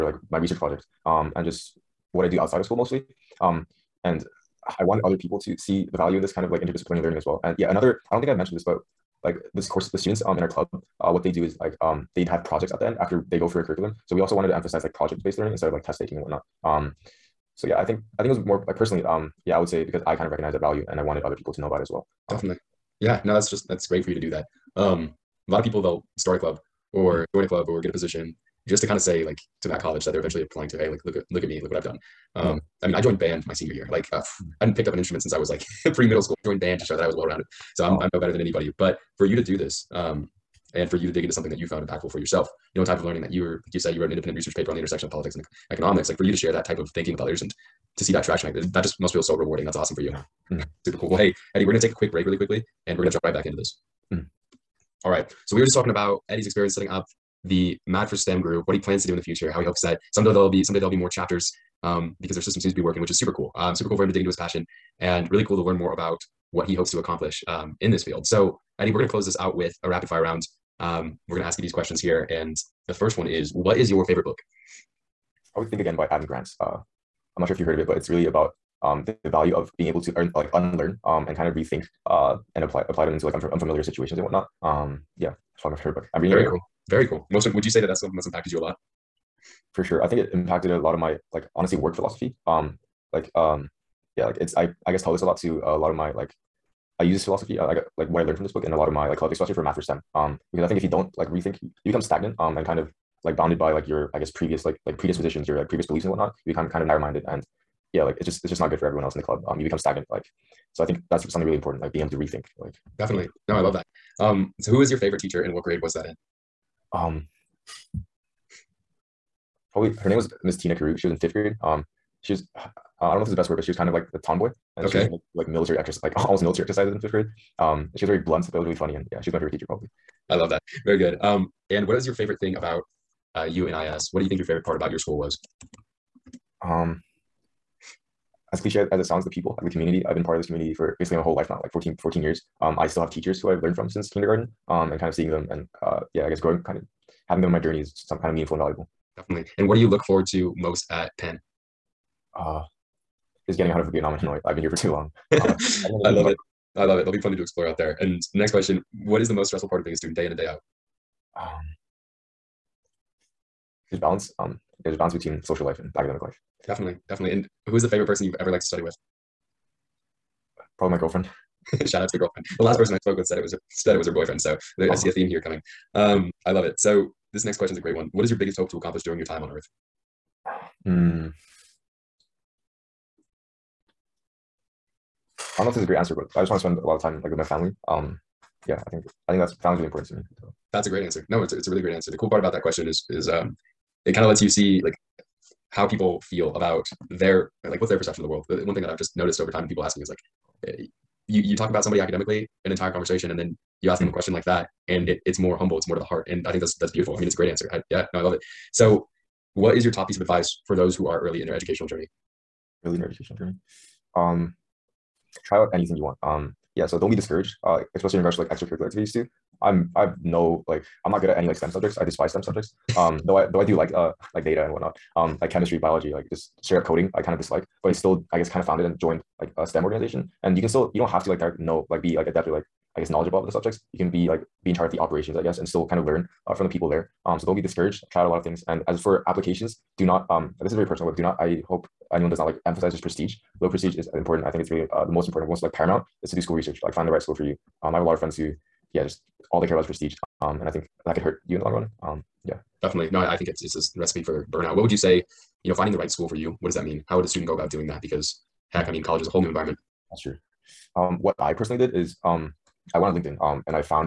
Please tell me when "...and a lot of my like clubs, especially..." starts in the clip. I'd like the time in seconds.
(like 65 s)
98 s.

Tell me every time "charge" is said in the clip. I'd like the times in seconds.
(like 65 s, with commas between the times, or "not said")
234 s.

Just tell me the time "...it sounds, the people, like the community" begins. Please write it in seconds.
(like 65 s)
138 s.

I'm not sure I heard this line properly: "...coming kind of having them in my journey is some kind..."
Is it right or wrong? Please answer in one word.
wrong.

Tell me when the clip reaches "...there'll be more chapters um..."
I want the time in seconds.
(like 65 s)
60 s.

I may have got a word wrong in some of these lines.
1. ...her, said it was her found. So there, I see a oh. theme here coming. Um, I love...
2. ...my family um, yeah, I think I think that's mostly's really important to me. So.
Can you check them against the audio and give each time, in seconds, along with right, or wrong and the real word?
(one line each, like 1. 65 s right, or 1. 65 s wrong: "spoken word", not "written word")
1. 173 s wrong: "boyfriend", not "found"
2. 187 s wrong: "family", not "mostly".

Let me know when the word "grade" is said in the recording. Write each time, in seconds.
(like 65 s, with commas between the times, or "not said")
115 s, 121 s, 127 s.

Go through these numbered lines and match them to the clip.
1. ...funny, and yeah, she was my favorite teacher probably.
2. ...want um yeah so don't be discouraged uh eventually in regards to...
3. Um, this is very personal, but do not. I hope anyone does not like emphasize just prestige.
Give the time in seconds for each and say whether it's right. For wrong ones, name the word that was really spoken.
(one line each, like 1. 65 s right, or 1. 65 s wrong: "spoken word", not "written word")
1. 128 s right
2. 216 s wrong: "especially", not "eventually"
3. 240 s right.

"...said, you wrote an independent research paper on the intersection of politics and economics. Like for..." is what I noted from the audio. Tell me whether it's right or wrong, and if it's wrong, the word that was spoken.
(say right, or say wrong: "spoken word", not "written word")
right.